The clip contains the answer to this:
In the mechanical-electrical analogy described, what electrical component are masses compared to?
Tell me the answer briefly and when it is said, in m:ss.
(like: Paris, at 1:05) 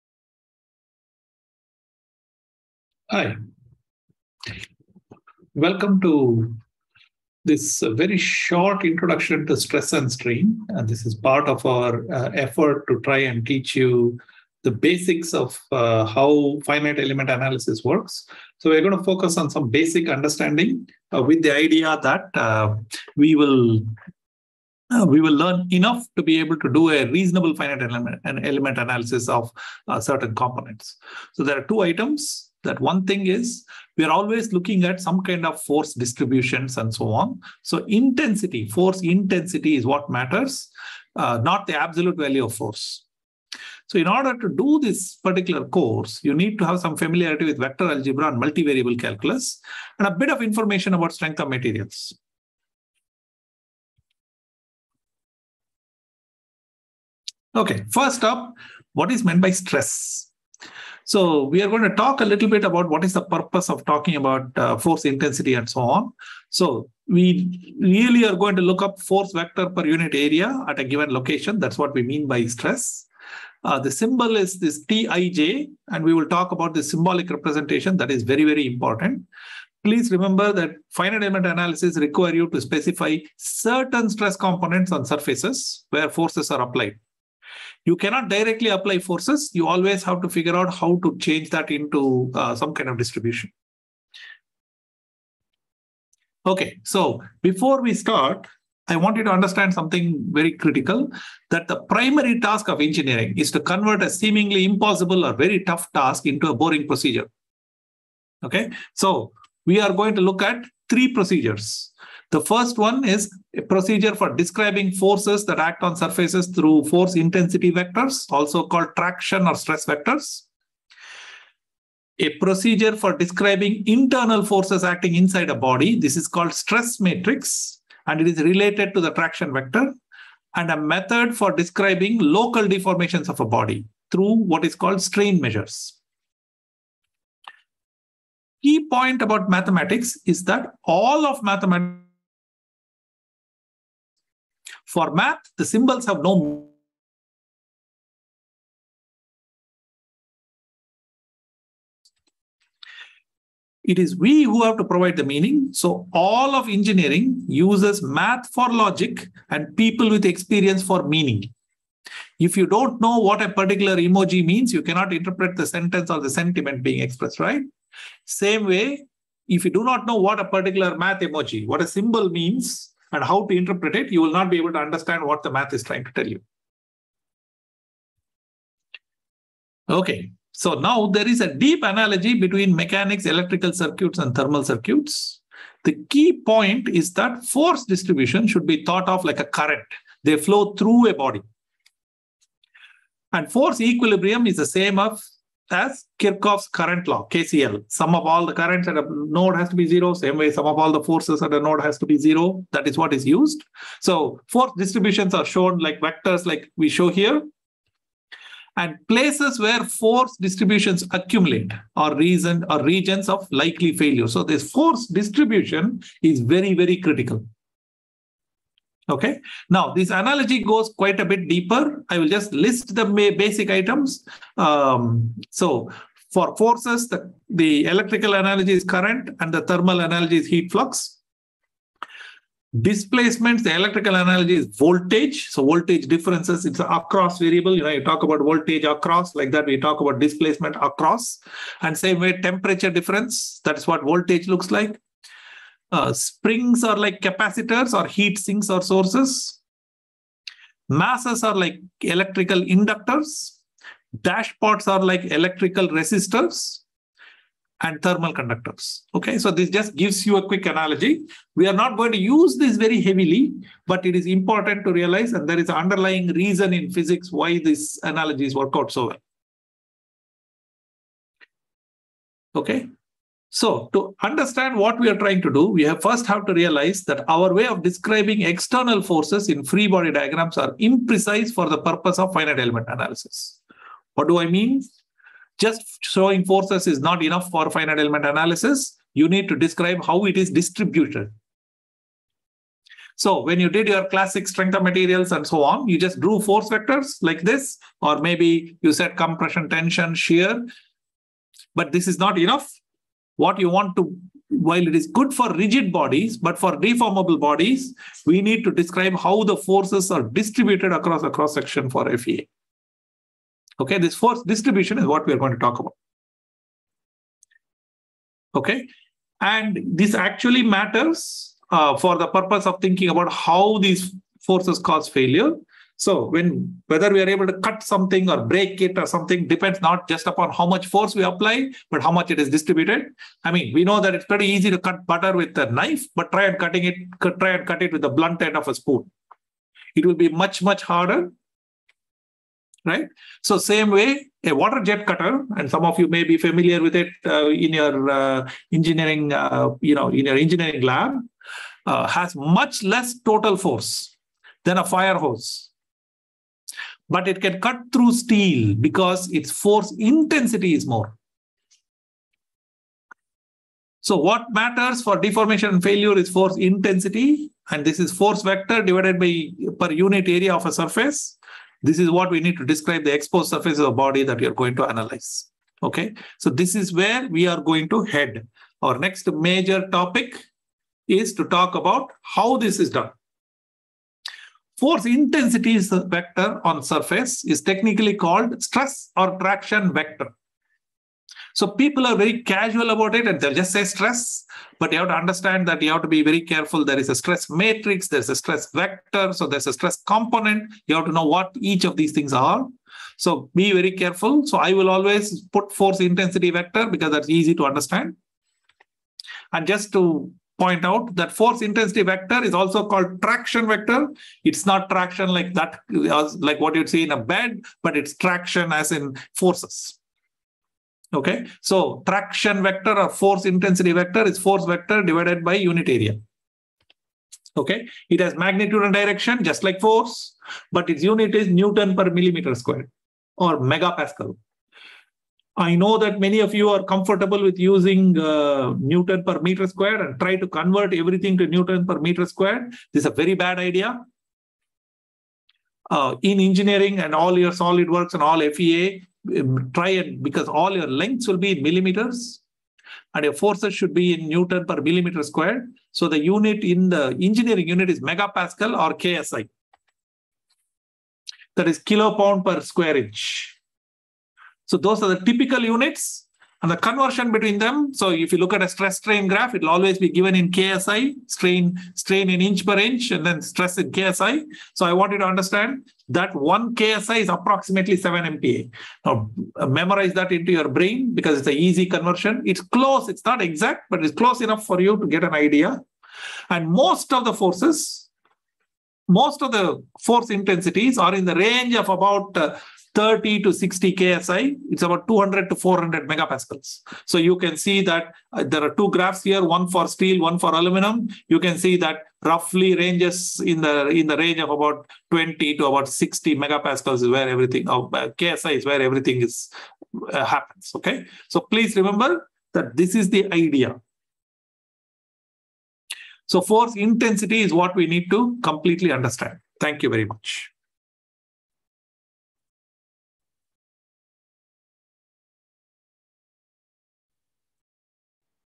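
Inductors, at 4:12.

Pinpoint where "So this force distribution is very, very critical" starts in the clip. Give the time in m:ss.
3:34.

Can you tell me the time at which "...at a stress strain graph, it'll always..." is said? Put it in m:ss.
7:48.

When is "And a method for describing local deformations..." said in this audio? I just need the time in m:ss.
2:10.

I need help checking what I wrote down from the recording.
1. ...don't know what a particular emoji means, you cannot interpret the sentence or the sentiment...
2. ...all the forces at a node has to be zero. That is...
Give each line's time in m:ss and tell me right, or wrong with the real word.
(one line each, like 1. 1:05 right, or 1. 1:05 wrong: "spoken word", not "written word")
1. 2:42 right
2. 3:20 right.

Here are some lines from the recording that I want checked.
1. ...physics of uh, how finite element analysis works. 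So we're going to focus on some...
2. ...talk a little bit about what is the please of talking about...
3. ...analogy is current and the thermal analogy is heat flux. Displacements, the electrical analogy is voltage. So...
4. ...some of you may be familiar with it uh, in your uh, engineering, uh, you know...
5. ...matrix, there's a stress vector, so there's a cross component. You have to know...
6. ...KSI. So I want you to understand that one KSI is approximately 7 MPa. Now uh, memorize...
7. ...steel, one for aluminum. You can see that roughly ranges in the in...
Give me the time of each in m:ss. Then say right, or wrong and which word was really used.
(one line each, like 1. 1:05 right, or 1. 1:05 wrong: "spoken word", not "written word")
1. 0:14 wrong: "basics", not "physics"
2. 1:01 wrong: "purpose", not "please"
3. 3:48 right
4. 5:45 right
5. 6:37 wrong: "stress", not "cross"
6. 7:53 right
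7. 8:19 right.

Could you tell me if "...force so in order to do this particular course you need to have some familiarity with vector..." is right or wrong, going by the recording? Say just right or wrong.
right.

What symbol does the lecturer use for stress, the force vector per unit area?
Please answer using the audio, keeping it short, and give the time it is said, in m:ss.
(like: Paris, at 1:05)
Tij, at 1:14.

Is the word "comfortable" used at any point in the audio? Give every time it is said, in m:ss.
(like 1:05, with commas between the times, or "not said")
7:16.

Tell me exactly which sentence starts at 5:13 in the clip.
Okay, this force distribution is what we are going to talk about.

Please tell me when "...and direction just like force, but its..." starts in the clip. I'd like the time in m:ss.
7:08.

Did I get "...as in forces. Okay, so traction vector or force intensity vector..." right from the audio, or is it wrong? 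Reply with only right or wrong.
right.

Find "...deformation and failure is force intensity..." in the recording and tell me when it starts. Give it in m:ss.
6:05.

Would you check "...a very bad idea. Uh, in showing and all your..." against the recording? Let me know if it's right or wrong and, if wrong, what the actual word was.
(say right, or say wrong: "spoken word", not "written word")
wrong: "engineering", not "showing".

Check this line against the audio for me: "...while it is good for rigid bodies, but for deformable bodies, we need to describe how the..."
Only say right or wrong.
right.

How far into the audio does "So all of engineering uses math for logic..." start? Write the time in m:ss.
2:35.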